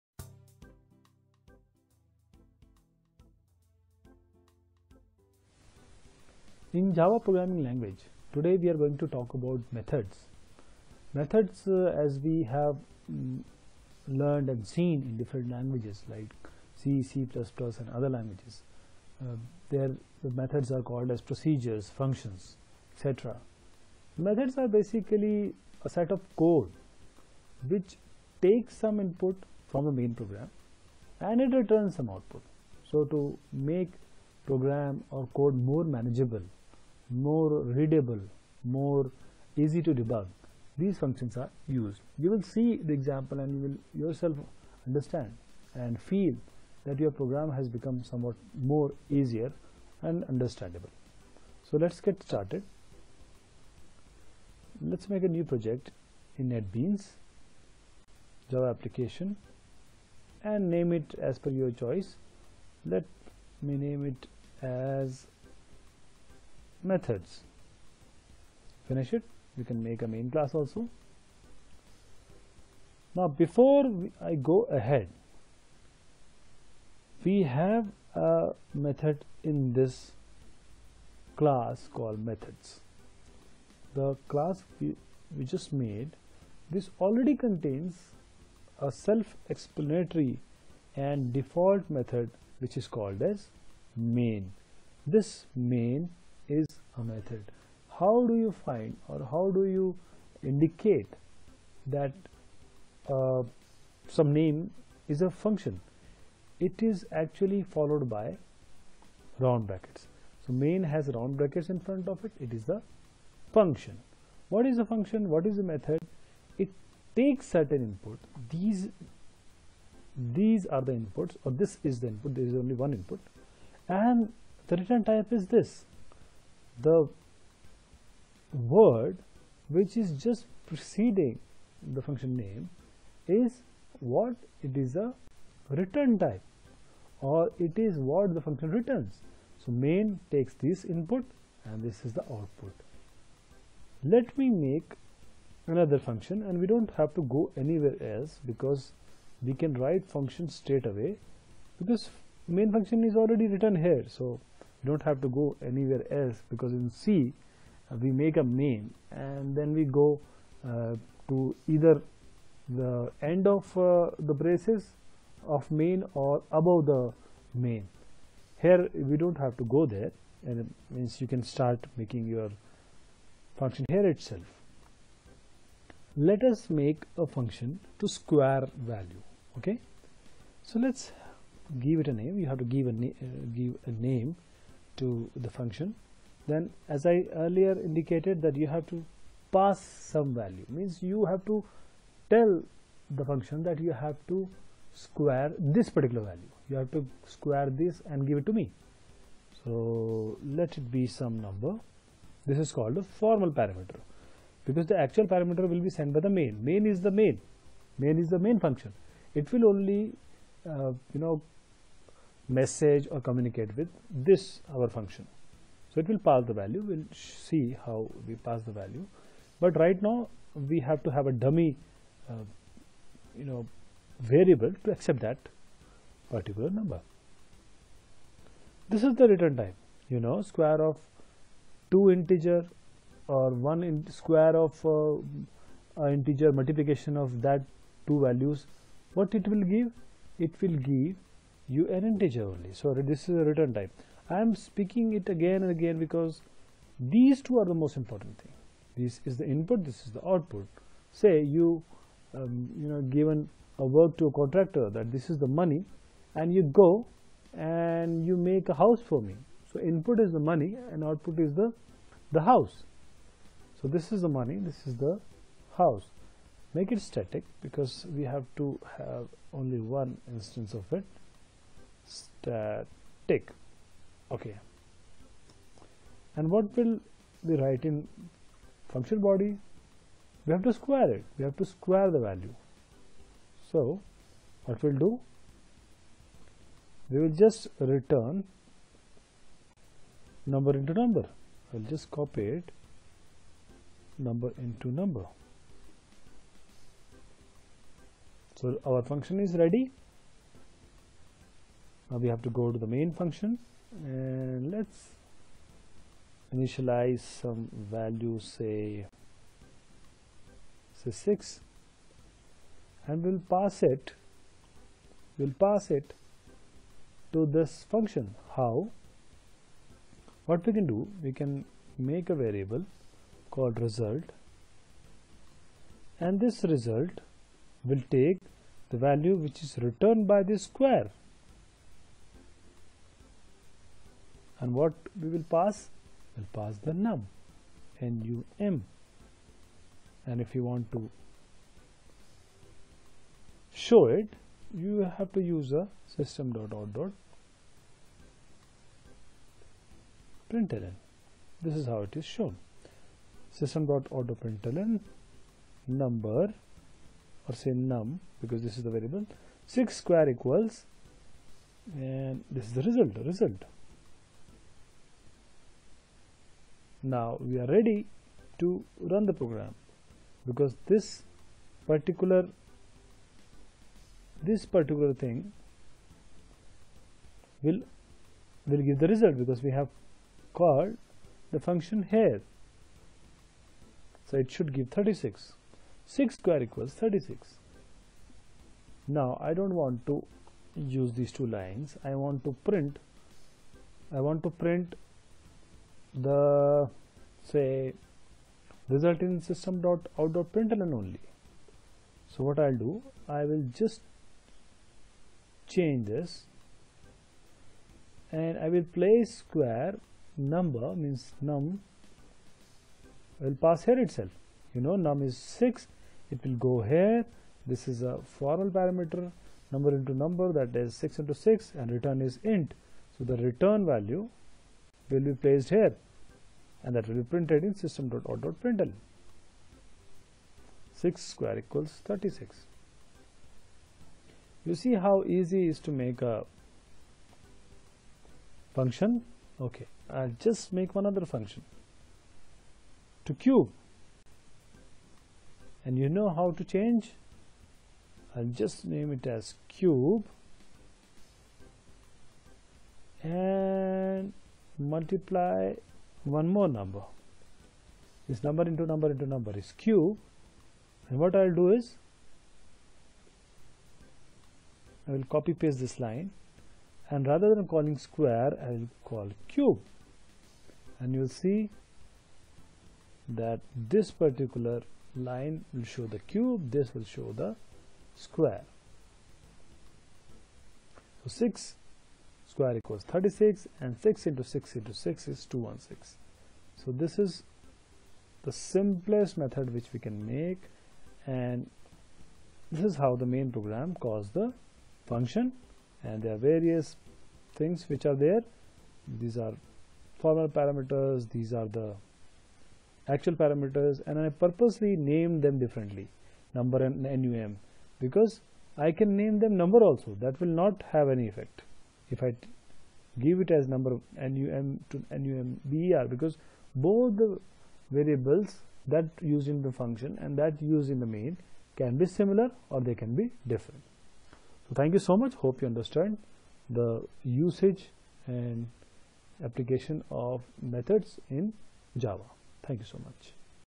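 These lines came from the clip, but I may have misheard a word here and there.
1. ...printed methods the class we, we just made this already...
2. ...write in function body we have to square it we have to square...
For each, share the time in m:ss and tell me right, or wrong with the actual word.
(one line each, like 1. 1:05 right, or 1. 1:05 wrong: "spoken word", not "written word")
1. 1:21 wrong: "called", not "printed"
2. 4:37 right.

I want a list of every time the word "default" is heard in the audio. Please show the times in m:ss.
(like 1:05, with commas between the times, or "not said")
1:31.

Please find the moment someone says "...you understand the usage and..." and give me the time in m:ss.
8:45.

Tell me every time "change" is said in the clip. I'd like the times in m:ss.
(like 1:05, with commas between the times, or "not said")
6:45, 7:26.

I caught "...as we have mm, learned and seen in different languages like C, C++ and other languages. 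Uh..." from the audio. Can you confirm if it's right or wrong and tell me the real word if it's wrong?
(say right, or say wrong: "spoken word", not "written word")
right.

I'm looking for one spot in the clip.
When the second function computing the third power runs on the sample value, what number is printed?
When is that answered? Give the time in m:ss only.
8:05.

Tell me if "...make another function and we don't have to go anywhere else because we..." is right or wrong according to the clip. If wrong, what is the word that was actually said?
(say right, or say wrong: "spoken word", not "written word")
right.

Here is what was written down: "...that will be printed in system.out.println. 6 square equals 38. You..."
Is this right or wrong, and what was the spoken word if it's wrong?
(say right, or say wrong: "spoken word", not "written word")
wrong: "36", not "38".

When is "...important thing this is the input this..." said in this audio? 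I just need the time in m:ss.
4:07.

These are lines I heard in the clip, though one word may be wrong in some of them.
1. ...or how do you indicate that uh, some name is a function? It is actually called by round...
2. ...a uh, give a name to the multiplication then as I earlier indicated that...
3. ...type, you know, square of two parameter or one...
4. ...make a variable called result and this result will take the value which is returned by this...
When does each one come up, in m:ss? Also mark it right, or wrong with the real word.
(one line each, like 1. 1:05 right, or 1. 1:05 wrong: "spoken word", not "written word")
1. 1:39 wrong: "followed", not "called"
2. 3:02 wrong: "function", not "multiplication"
3. 3:49 wrong: "integer", not "parameter"
4. 5:22 right.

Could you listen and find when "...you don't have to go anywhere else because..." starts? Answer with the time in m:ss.
2:34.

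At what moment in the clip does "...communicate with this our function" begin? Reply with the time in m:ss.
3:33.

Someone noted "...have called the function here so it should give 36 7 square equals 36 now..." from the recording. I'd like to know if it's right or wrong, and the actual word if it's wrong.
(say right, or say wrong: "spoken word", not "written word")
wrong: "6", not "7".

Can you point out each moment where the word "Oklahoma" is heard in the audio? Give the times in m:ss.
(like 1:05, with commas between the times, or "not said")
not said.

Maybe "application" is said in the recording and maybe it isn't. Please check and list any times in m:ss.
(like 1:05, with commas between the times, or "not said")
0:58, 8:49.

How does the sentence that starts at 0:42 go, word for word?
You will see the example and you will yourself understand and feel that your program has become somewhat more easier and understandable.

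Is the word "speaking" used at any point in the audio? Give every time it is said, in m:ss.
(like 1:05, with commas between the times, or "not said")
4:04.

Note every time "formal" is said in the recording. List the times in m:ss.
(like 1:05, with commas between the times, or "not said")
3:23, 6:58, 8:20.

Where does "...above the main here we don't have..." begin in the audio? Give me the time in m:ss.
2:46.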